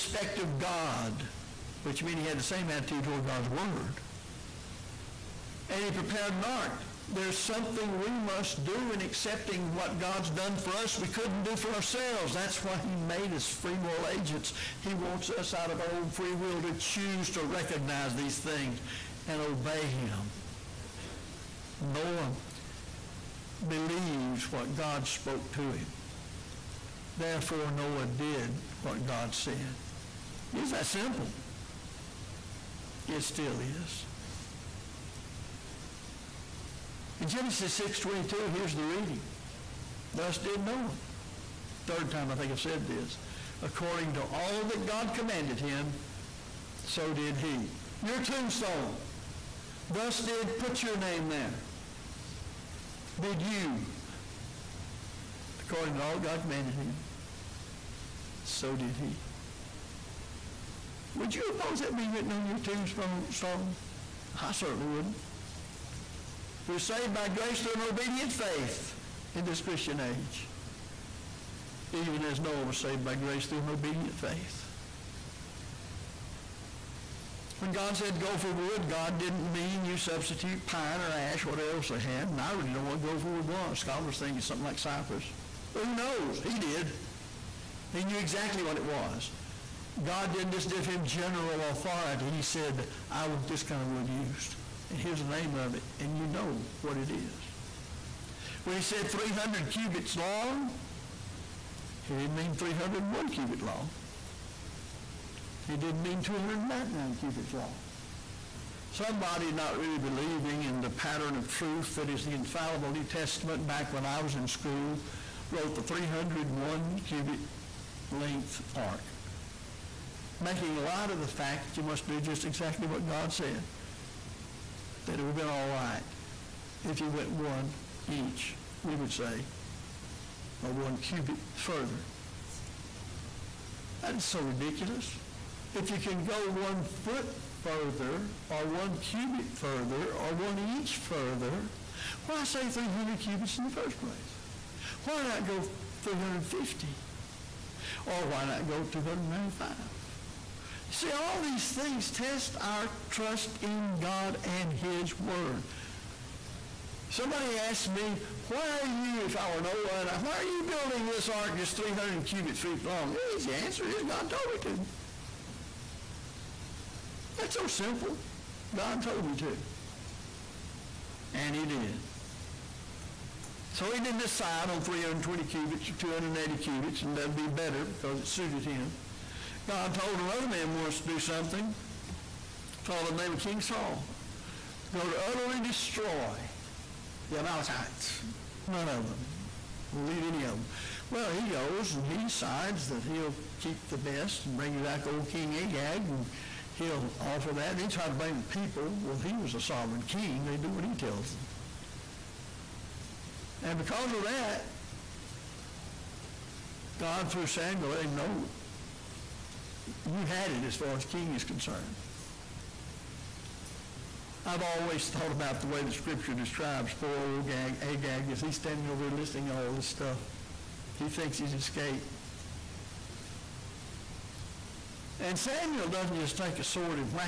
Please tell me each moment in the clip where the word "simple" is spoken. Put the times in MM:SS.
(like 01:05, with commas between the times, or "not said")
00:30, 02:47.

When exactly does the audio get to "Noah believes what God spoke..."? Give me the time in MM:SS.
00:21.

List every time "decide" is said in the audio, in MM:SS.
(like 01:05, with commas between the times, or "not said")
02:54, 03:12.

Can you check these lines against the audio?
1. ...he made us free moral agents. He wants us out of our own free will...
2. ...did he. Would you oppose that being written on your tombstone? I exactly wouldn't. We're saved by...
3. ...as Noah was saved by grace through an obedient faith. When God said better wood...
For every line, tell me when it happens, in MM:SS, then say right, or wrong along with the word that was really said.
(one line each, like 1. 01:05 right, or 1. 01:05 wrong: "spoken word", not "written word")
1. 00:12 right
2. 00:58 wrong: "certainly", not "exactly"
3. 01:12 wrong: "gopher", not "better".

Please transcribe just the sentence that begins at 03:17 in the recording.
And he tried to blame the people.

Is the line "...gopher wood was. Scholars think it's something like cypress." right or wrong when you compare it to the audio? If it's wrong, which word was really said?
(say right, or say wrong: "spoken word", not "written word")
right.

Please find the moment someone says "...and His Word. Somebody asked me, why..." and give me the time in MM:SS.
02:34.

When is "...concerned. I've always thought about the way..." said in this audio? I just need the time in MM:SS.
03:31.